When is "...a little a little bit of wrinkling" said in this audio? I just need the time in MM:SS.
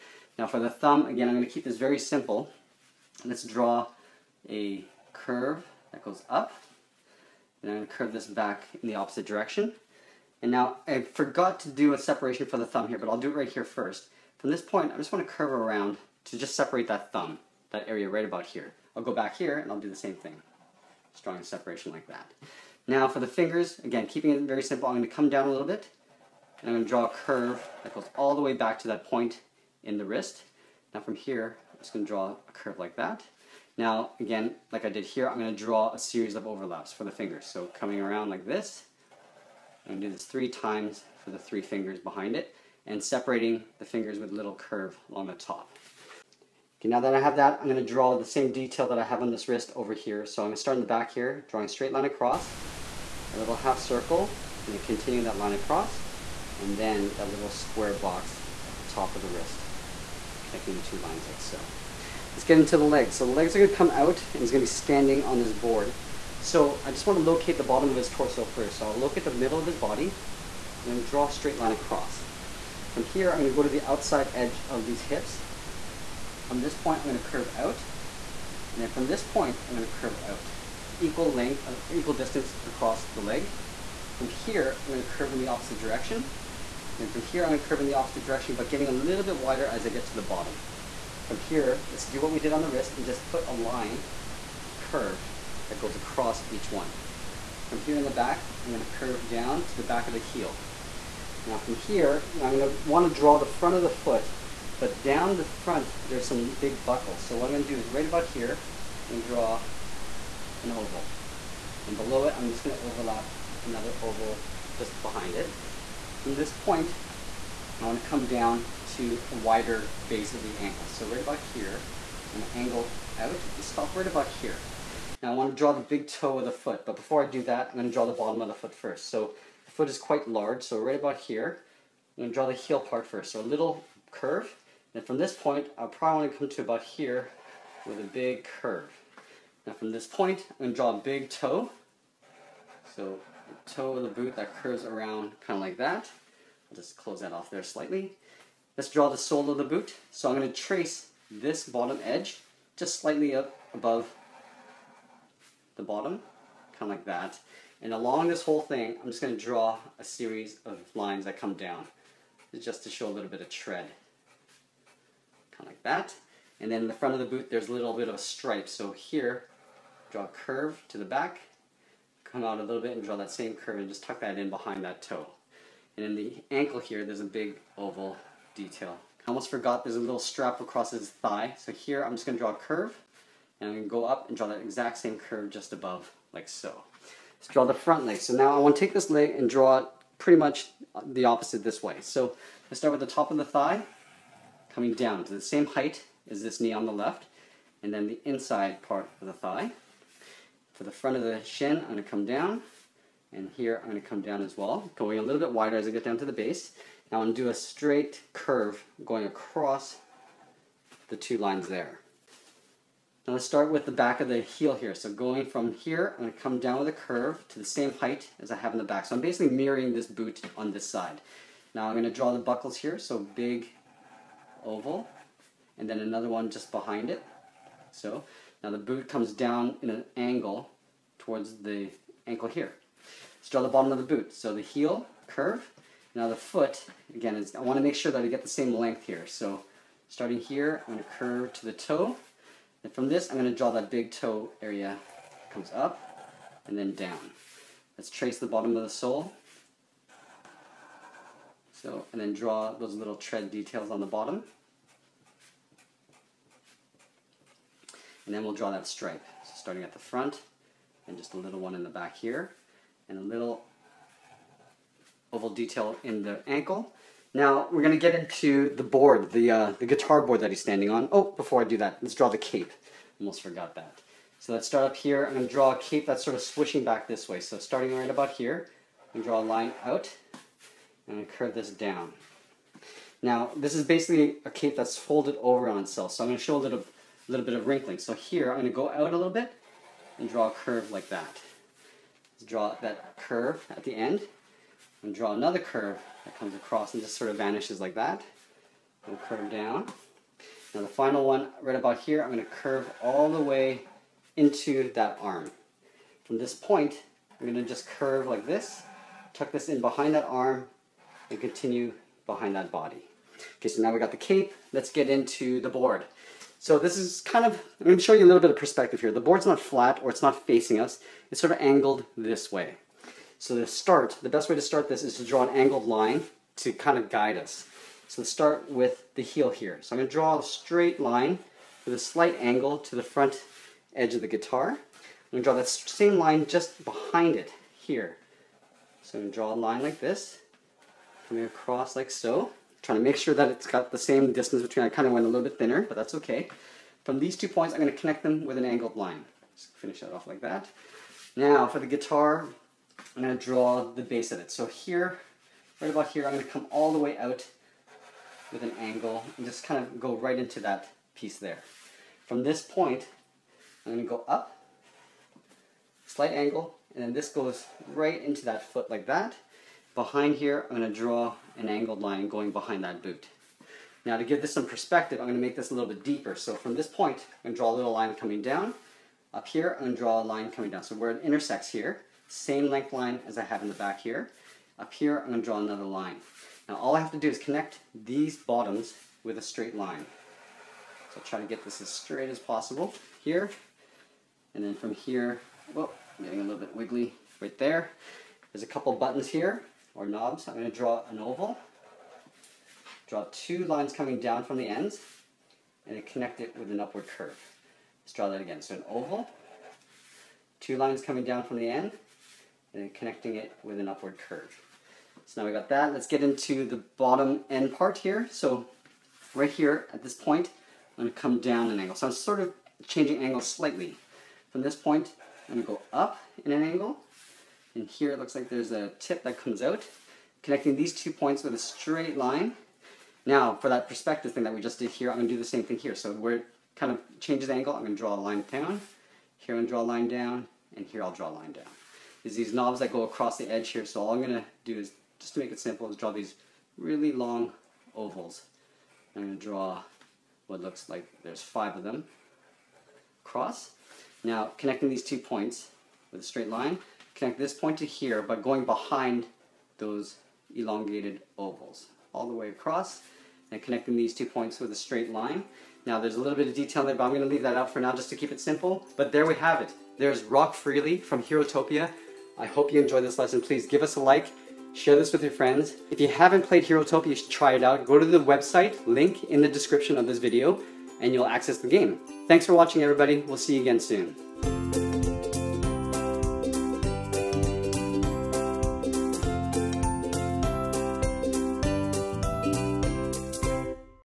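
04:46.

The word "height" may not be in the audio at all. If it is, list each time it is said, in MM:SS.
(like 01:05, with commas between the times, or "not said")
03:15, 03:37.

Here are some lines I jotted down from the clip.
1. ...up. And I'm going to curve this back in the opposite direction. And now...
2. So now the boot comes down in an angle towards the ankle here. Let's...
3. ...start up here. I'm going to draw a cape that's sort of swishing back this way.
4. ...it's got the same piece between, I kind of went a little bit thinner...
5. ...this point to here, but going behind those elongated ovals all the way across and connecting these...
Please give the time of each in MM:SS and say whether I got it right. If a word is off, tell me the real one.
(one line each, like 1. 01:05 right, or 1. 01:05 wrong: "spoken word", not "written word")
1. 00:06 right
2. 03:47 right
3. 04:34 right
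4. 05:43 wrong: "distance", not "piece"
5. 07:37 right.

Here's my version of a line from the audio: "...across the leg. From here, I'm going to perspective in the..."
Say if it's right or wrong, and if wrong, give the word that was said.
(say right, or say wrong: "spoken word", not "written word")
wrong: "curve", not "perspective".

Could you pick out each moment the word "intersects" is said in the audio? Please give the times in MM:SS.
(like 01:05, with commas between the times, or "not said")
06:21.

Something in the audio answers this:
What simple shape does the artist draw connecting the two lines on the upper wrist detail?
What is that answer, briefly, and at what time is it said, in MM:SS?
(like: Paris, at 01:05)
square box, at 00:57.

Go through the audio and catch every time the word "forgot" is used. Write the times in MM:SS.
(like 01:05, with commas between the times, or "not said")
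00:11, 02:59, 04:33.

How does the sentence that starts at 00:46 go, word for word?
Okay, now that I have that, I'm going to draw the same detail that I have on this wrist over here.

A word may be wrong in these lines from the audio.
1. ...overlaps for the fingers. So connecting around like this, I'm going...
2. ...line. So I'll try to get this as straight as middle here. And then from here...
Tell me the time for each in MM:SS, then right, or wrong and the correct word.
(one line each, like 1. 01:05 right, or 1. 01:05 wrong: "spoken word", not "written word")
1. 00:36 wrong: "coming", not "connecting"
2. 06:29 wrong: "possible", not "middle".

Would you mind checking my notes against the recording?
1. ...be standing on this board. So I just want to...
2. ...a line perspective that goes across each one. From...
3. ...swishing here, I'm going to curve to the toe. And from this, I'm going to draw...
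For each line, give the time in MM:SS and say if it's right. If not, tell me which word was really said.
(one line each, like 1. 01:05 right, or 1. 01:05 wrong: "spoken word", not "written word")
1. 01:04 right
2. 01:33 wrong: "curve", not "perspective"
3. 04:00 wrong: "starting", not "swishing".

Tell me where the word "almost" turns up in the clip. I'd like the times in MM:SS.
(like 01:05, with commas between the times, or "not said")
02:59, 04:33.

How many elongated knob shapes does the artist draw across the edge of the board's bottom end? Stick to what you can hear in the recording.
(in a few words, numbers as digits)
5.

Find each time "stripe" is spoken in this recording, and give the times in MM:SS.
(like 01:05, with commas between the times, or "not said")
02:48, 04:18.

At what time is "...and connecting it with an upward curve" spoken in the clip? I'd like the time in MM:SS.
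06:52.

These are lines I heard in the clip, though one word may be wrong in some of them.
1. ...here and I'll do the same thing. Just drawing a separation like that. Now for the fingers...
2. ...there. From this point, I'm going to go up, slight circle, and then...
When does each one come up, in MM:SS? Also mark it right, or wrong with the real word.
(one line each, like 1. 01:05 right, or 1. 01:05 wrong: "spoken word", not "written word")
1. 00:19 right
2. 06:01 wrong: "angle", not "circle".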